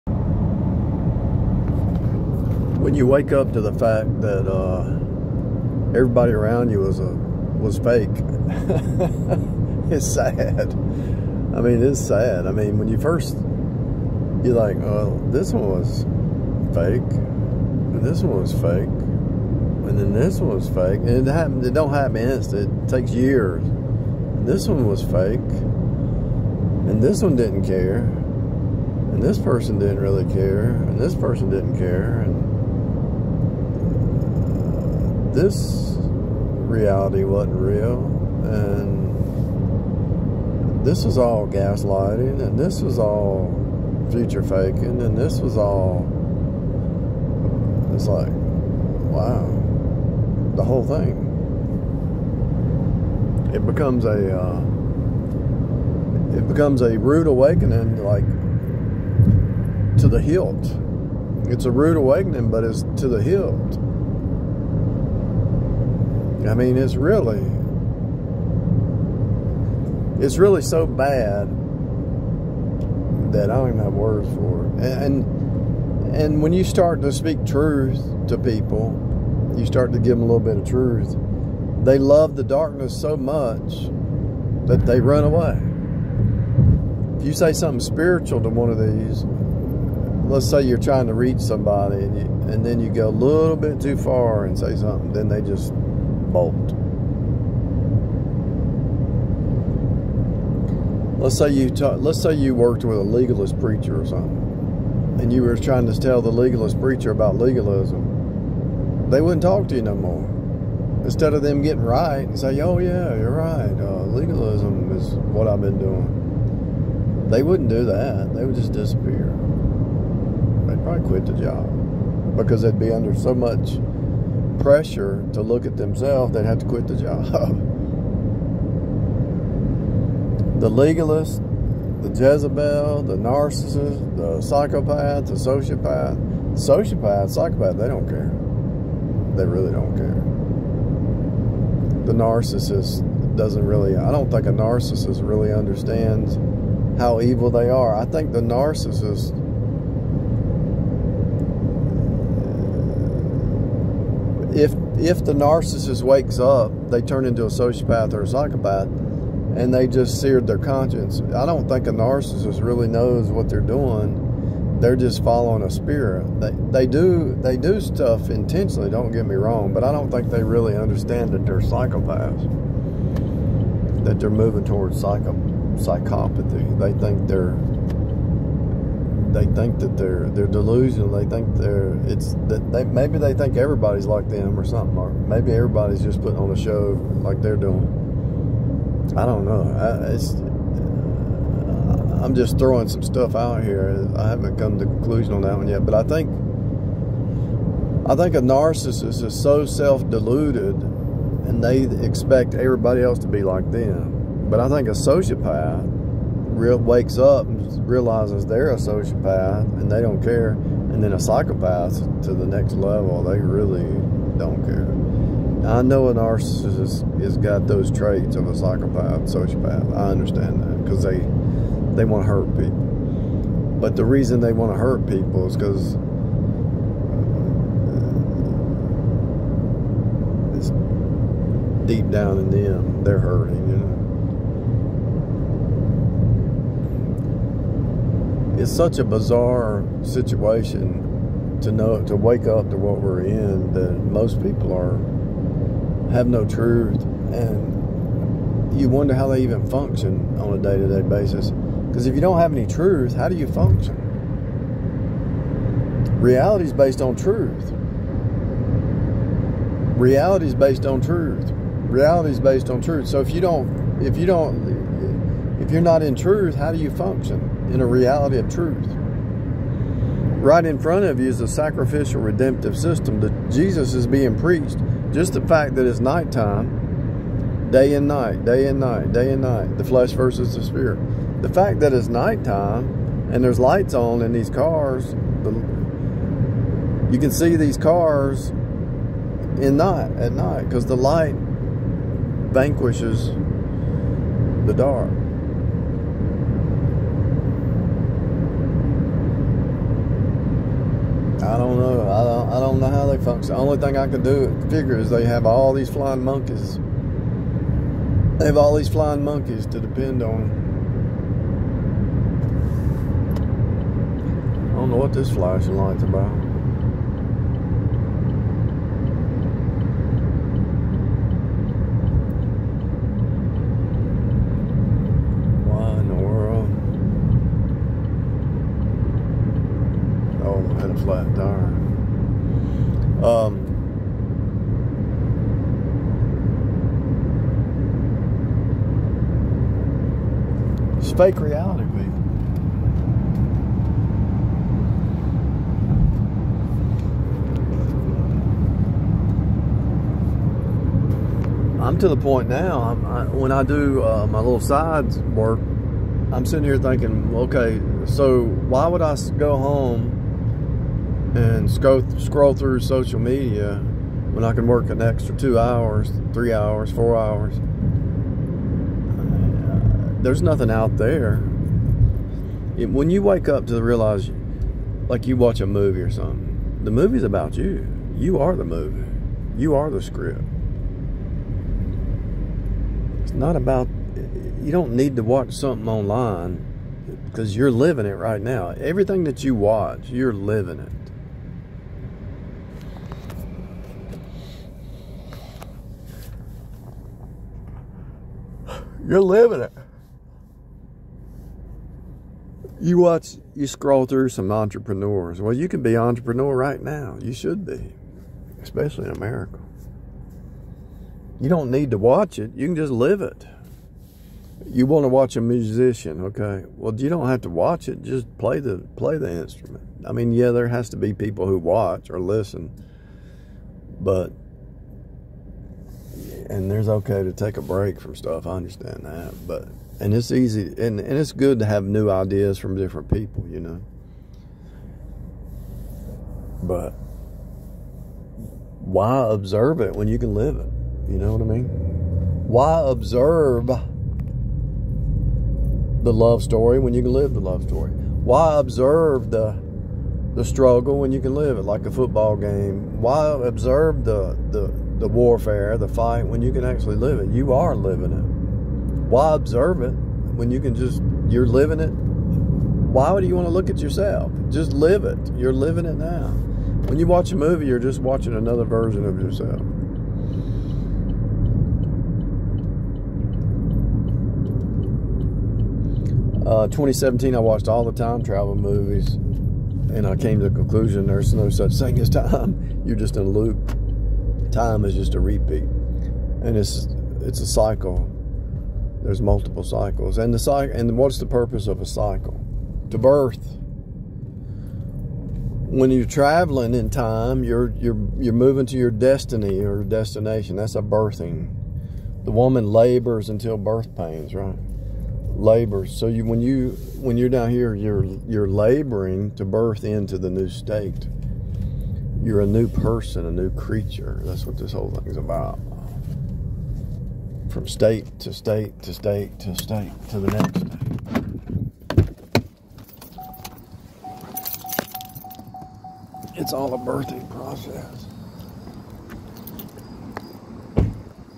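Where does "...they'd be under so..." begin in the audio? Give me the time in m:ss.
2:02.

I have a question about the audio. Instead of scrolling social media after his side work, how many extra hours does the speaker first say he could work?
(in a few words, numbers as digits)
2.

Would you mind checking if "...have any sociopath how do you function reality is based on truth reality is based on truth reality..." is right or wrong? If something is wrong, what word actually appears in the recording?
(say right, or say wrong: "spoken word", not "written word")
wrong: "truth", not "sociopath".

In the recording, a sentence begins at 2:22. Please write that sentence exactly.
The narcissist doesn't really, I don't think a narcissist really understands how evil they are.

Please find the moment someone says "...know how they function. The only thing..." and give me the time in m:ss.
5:02.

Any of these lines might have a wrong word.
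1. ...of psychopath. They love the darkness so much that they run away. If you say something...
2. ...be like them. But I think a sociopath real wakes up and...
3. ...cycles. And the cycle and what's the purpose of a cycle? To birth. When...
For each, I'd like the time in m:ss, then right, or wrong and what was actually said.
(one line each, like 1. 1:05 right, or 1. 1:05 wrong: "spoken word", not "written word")
1. 1:20 wrong: "truth", not "psychopath"
2. 3:23 right
3. 8:09 right.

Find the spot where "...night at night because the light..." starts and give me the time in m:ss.
4:49.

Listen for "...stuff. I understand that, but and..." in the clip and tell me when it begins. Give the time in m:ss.
7:08.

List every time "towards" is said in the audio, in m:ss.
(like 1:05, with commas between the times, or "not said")
2:54.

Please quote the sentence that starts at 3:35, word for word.
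I know a narcissist has got those traits of a psychopath, sociopath.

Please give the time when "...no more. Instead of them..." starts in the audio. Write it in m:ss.
1:49.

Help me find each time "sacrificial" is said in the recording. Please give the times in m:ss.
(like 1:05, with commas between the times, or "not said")
4:31.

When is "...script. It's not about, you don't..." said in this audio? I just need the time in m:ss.
6:20.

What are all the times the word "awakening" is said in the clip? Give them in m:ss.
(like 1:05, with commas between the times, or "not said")
0:57, 1:01.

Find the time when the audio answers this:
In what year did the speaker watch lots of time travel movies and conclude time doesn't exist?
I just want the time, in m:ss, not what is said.
7:56.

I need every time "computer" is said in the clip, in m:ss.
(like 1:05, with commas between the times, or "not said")
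not said.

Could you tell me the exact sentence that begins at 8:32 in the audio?
You're a new person, a new creature.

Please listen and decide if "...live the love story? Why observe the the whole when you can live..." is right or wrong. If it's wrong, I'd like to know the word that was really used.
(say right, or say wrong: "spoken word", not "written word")
wrong: "struggle", not "whole".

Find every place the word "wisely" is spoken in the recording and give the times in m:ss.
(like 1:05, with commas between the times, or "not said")
not said.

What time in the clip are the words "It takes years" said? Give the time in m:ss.
0:22.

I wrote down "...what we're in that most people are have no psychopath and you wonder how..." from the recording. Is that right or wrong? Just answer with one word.
wrong.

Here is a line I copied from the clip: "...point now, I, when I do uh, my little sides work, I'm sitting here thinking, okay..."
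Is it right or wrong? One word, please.
right.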